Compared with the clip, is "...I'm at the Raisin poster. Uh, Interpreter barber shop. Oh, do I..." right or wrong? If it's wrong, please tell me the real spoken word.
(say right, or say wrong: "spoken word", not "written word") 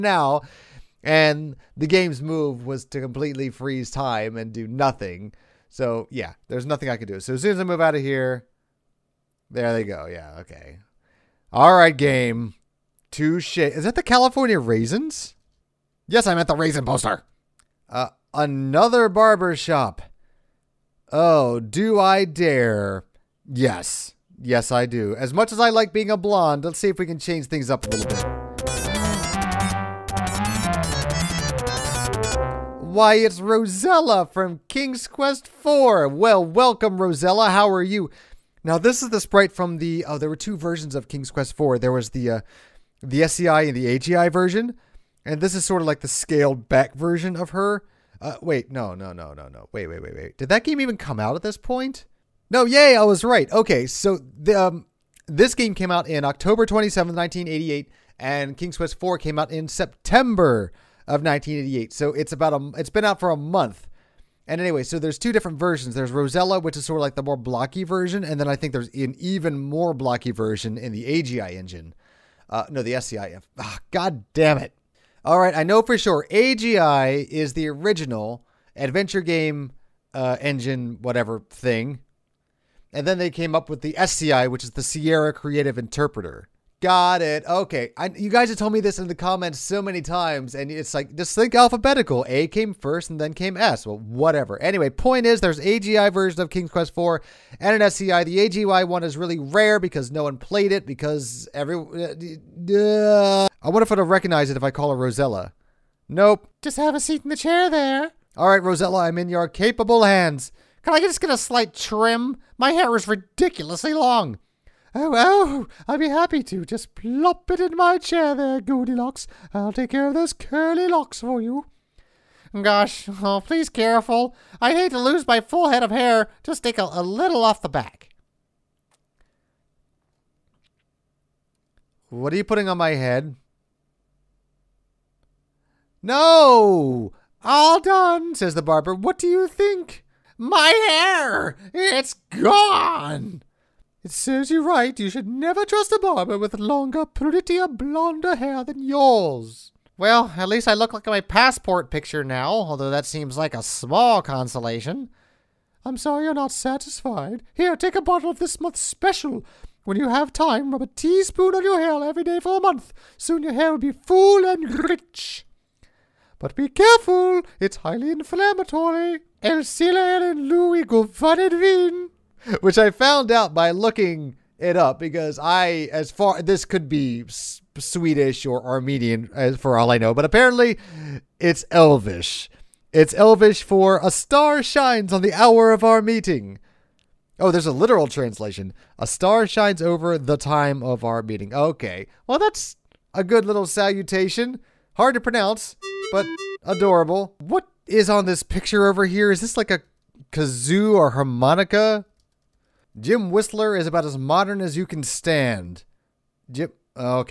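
wrong: "Another", not "Interpreter".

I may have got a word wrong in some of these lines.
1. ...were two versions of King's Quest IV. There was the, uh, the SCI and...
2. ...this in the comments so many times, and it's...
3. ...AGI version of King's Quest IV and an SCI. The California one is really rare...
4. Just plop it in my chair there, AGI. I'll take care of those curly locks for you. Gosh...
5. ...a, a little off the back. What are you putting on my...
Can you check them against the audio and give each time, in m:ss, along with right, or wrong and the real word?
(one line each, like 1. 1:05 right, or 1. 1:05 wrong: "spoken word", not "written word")
1. 0:40 right
2. 1:28 right
3. 1:35 wrong: "AGI", not "California"
4. 1:56 wrong: "Goldilocks", not "AGI"
5. 2:06 right.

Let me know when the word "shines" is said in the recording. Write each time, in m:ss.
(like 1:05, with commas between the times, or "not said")
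3:04, 3:09.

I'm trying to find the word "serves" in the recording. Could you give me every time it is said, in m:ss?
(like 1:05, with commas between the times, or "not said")
2:24.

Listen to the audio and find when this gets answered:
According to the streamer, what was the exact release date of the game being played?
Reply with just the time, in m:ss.
0:56.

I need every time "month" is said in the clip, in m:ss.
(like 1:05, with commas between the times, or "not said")
1:03, 2:38, 2:42.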